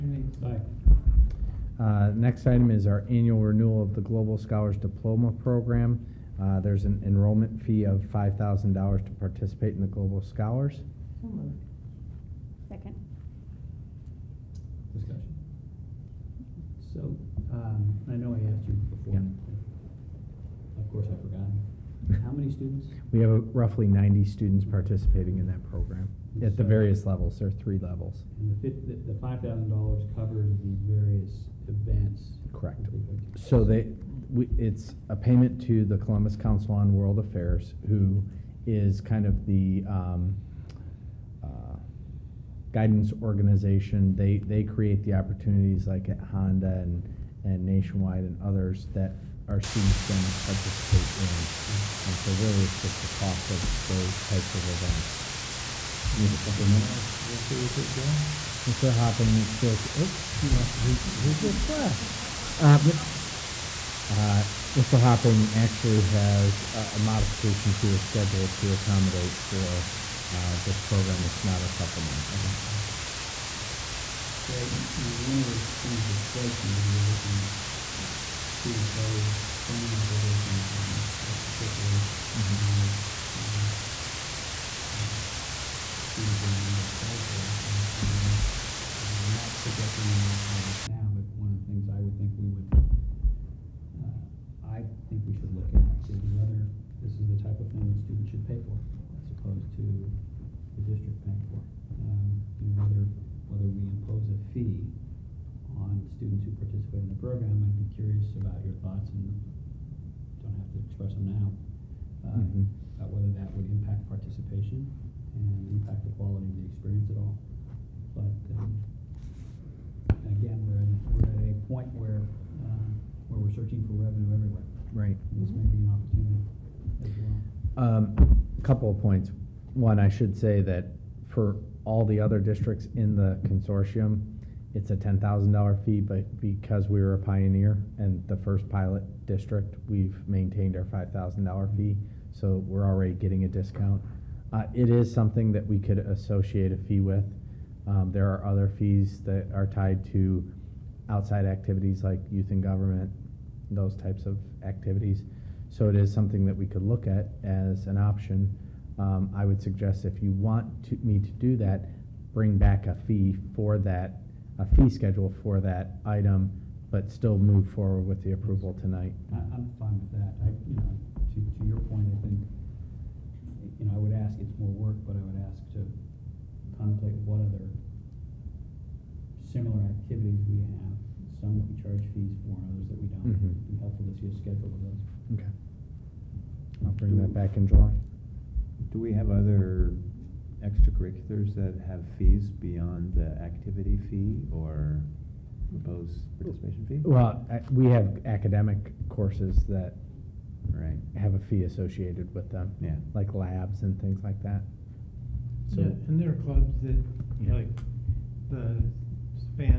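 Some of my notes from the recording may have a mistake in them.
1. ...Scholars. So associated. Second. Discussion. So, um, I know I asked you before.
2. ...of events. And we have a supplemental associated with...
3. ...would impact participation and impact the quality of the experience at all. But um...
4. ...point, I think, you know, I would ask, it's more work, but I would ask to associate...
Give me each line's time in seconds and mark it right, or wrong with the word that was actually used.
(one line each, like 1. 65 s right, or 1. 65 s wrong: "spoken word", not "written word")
1. 10 s wrong: "moved", not "associated"
2. 54 s right
3. 113 s right
4. 171 s wrong: "contemplate", not "associate".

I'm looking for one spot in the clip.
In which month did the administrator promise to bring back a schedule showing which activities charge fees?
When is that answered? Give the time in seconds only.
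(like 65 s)
187 s.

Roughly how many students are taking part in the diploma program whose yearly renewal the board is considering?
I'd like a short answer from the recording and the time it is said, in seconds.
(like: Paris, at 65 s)
90, at 23 s.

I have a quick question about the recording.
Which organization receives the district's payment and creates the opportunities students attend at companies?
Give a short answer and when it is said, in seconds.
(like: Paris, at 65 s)
Columbus Council on World Affairs, at 35 s.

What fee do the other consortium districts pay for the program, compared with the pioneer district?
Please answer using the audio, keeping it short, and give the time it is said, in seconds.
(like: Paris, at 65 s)
$10,000, at 134 s.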